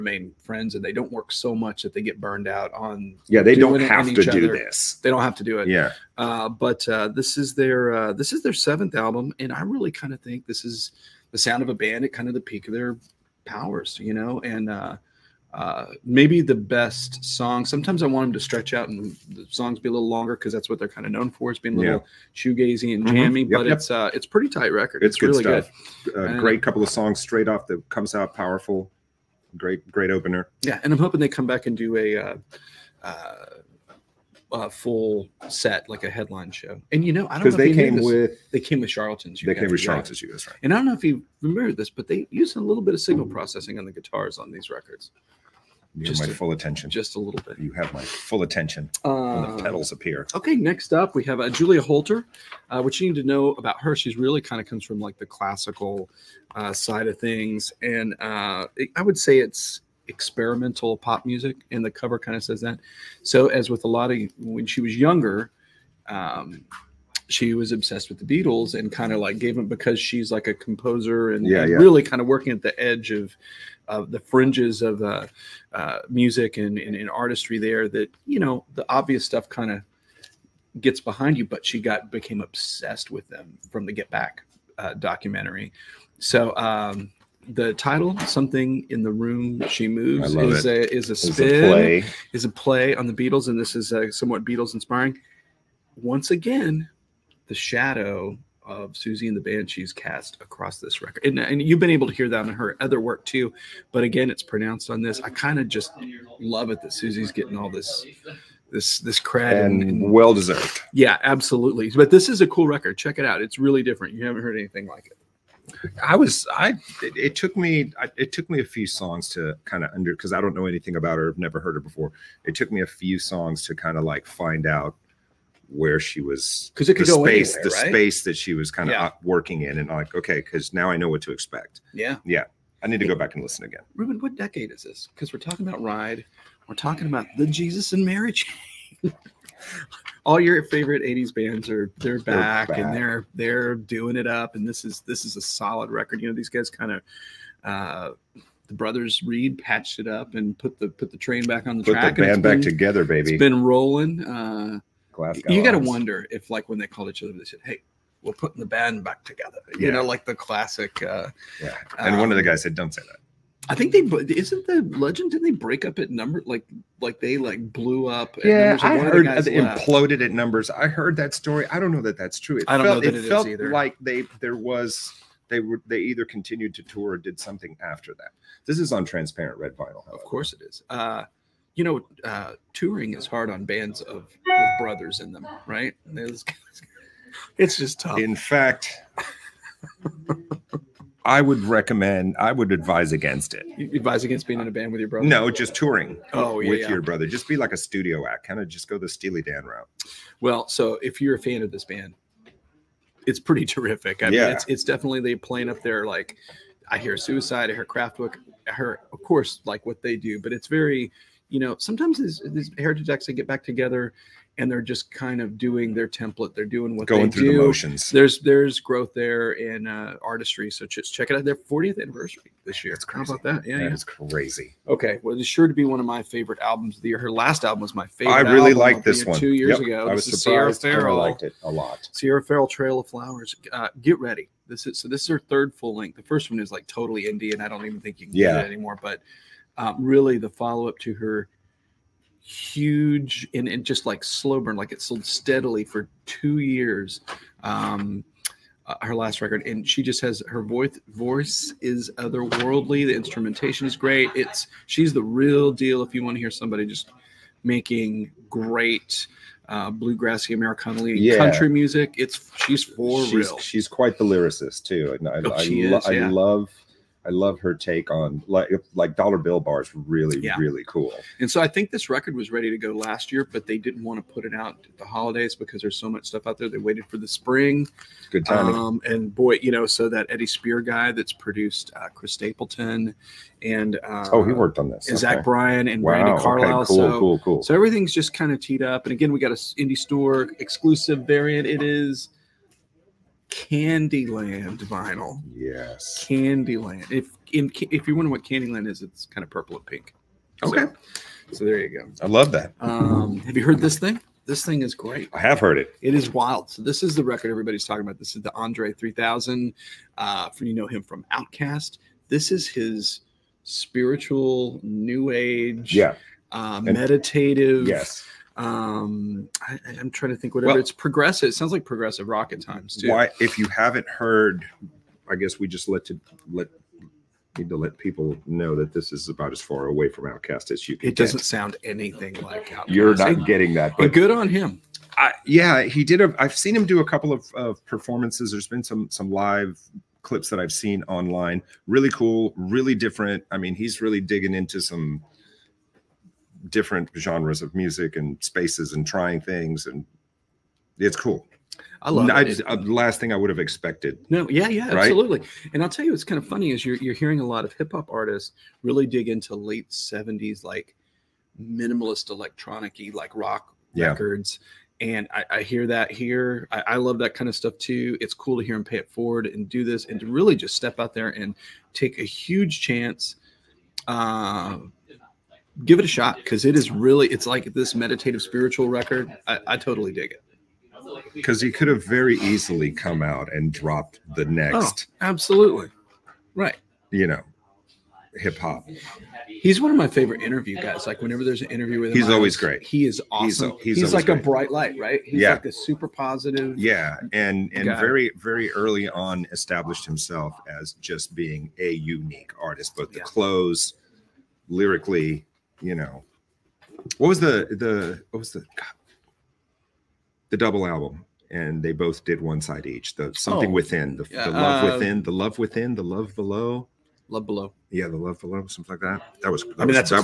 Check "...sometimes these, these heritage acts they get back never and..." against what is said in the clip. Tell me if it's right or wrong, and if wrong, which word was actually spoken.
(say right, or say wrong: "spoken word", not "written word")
wrong: "together", not "never".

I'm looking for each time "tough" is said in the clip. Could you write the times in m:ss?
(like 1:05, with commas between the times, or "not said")
3:07.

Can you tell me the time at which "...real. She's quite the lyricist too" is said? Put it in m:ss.
4:23.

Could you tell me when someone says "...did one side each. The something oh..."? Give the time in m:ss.
6:52.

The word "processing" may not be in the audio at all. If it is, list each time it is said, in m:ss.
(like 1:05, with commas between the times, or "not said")
0:43.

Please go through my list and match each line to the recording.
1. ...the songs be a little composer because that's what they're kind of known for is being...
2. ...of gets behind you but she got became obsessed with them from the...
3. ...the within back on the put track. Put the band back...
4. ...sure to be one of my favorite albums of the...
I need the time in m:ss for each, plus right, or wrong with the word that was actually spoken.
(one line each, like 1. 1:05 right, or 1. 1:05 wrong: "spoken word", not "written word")
1. 0:19 wrong: "longer", not "composer"
2. 1:19 right
3. 2:31 wrong: "train", not "within"
4. 3:45 right.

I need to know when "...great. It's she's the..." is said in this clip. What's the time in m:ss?
4:13.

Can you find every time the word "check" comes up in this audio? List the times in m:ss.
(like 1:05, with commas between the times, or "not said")
1:52, 3:41.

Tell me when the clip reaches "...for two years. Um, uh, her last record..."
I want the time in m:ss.
4:05.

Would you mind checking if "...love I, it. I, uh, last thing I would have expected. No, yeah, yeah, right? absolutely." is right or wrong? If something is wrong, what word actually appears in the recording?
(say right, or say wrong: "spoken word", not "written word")
right.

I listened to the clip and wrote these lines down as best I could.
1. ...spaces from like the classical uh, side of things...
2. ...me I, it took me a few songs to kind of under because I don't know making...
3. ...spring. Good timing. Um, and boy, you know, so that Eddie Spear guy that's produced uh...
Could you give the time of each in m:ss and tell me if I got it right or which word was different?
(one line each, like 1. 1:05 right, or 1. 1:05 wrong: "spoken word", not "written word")
1. 0:54 wrong: "comes", not "spaces"
2. 1:57 wrong: "anything", not "making"
3. 4:37 right.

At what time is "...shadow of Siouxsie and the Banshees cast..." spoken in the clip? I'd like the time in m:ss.
1:37.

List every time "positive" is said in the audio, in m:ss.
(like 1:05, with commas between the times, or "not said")
6:36.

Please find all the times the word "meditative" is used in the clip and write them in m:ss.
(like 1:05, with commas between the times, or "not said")
5:16, 6:17.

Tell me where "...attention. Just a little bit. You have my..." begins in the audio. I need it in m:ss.
0:46.